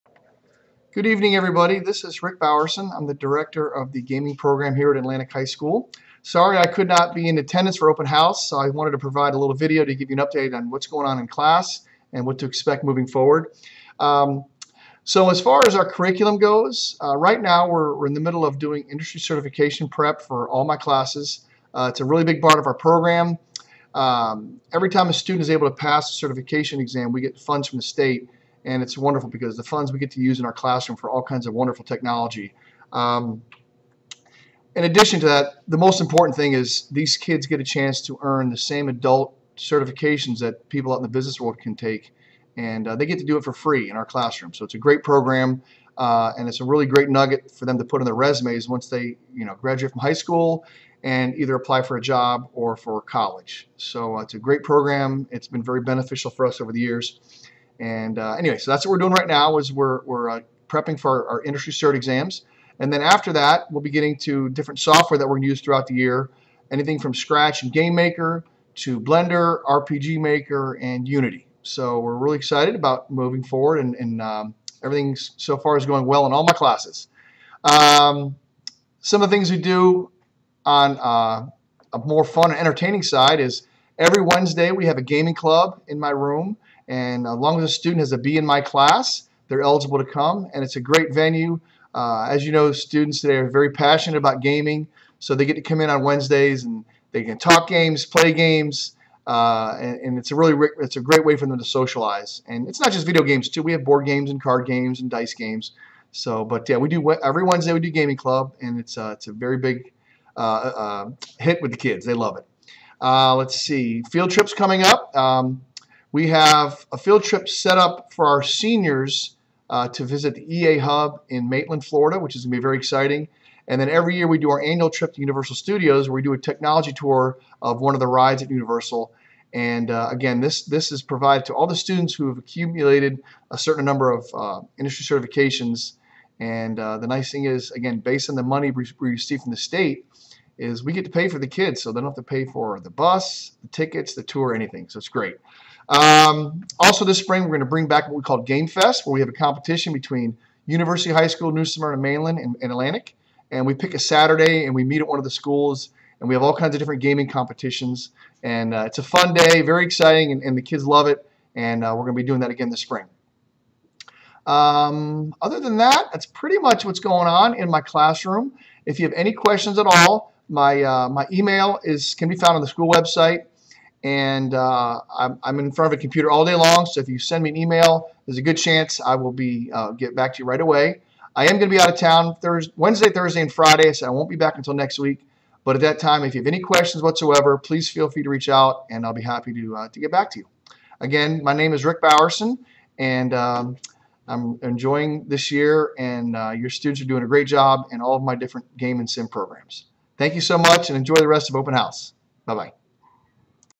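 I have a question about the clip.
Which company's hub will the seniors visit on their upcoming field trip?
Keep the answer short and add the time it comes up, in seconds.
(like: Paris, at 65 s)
EA, at 120 s.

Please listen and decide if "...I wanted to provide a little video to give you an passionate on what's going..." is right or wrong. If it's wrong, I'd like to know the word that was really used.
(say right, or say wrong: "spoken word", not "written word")
wrong: "update", not "passionate".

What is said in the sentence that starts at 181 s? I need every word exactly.
I am going to be out of town Thursday, Wednesday, Thursday, and Friday, so I won't be back until next week.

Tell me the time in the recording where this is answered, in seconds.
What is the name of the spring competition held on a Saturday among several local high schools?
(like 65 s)
148 s.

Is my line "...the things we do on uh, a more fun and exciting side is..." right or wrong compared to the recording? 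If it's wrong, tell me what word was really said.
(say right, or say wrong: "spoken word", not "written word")
wrong: "entertaining", not "exciting".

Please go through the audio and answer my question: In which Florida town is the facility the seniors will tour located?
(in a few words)
Maitland.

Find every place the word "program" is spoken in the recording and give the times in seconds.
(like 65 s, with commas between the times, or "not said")
4 s, 22 s, 45 s, 54 s, 199 s.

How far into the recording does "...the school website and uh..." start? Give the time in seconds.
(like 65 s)
172 s.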